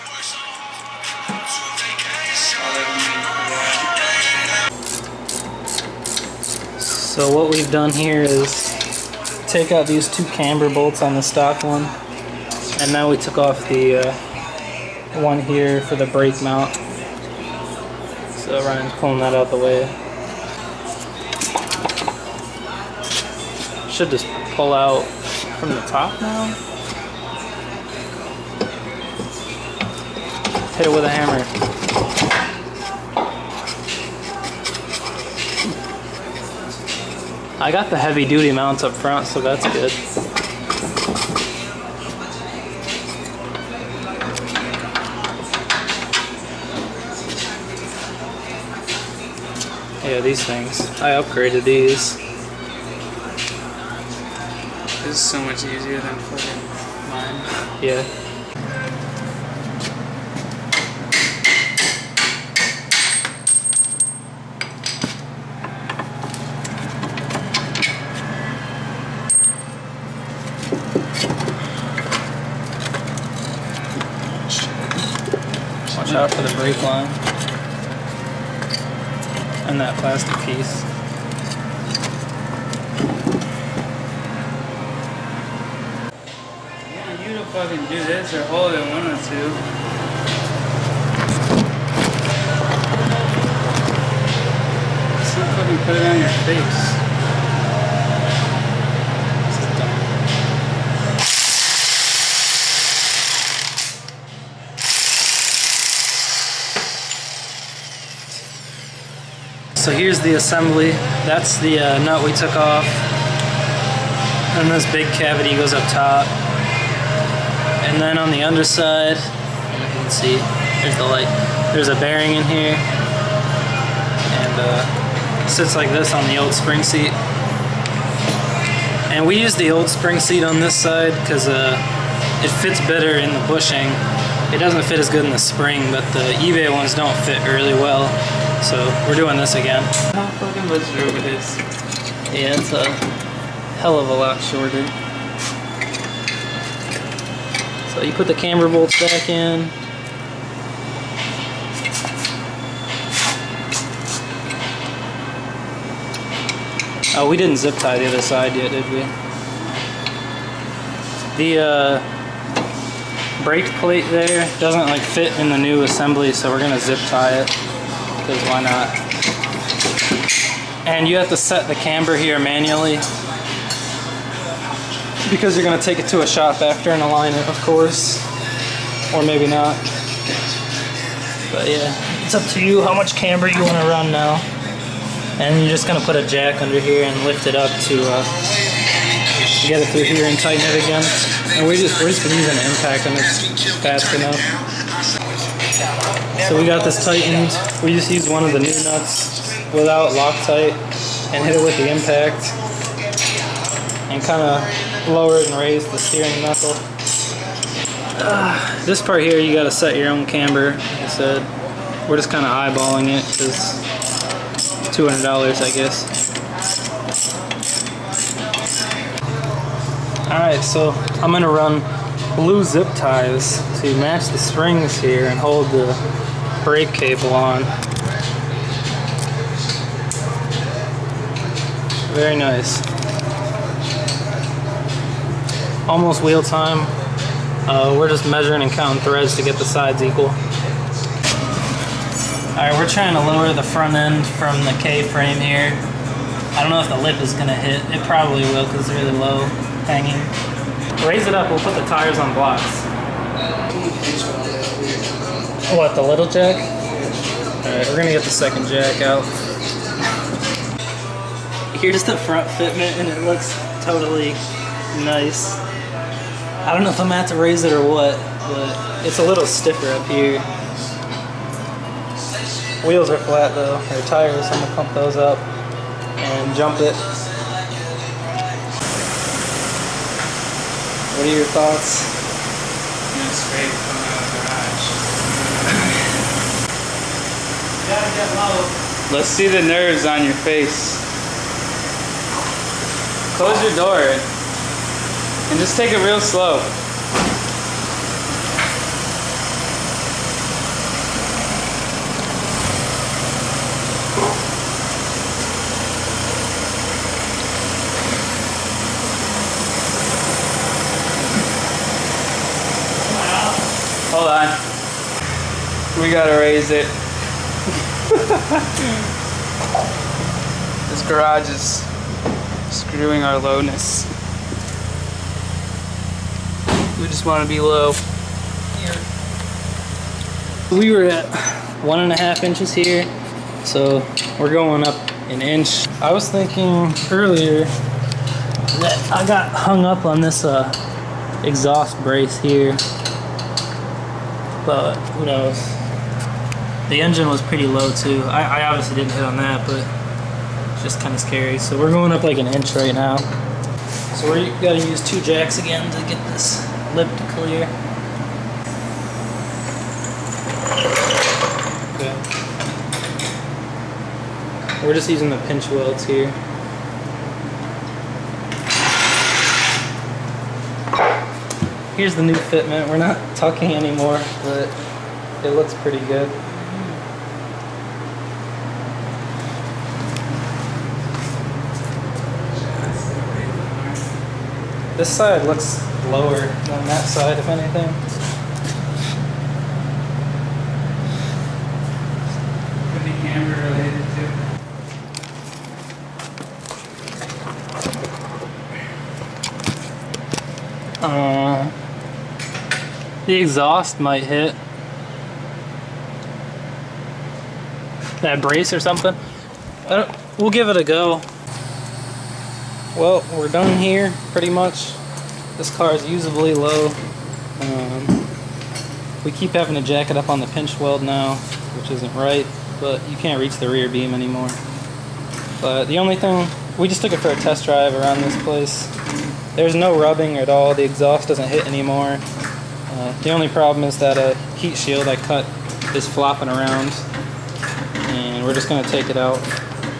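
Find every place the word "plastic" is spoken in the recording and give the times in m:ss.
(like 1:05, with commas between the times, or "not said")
1:19.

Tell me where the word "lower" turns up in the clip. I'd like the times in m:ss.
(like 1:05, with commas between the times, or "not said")
3:25, 4:03, 6:26.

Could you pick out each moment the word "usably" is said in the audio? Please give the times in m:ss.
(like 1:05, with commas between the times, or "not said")
6:56.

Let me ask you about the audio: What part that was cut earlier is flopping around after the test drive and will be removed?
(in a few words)
heat shield.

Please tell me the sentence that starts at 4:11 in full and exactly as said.
Raise it up, we'll put the tires on blocks.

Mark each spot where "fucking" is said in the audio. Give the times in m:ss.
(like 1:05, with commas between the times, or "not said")
0:56, 1:27, 2:20.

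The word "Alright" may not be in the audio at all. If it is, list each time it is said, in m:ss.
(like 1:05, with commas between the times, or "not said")
3:40, 4:02, 4:17.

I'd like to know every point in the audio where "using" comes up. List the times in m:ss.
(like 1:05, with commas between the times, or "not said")
3:12, 6:05.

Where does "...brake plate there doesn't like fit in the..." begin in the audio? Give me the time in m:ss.
2:43.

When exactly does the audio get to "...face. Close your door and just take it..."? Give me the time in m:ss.
4:50.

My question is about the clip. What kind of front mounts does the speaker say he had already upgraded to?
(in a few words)
heavy duty mounts.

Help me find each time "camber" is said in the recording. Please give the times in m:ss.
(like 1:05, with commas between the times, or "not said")
0:10, 2:28, 2:51, 3:03, 3:30.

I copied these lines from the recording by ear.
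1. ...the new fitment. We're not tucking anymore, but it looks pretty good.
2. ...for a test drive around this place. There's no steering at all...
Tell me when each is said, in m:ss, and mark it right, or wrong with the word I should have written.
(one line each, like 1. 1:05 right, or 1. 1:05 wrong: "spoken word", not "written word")
1. 6:12 right
2. 7:07 wrong: "rubbing", not "steering".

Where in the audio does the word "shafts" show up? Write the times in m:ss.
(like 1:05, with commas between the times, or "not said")
not said.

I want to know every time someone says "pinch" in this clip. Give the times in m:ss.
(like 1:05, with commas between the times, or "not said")
6:05, 7:00.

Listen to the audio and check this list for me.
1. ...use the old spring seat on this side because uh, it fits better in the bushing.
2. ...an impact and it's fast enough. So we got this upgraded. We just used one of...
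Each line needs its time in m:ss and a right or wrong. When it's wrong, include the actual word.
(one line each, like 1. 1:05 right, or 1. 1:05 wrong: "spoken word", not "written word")
1. 2:09 right
2. 3:12 wrong: "tightened", not "upgraded".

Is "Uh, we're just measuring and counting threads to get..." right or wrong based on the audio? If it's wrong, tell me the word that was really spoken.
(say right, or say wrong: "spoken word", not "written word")
right.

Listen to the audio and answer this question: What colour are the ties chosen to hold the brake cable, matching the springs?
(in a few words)
blue.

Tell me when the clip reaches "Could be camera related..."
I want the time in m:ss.
6:32.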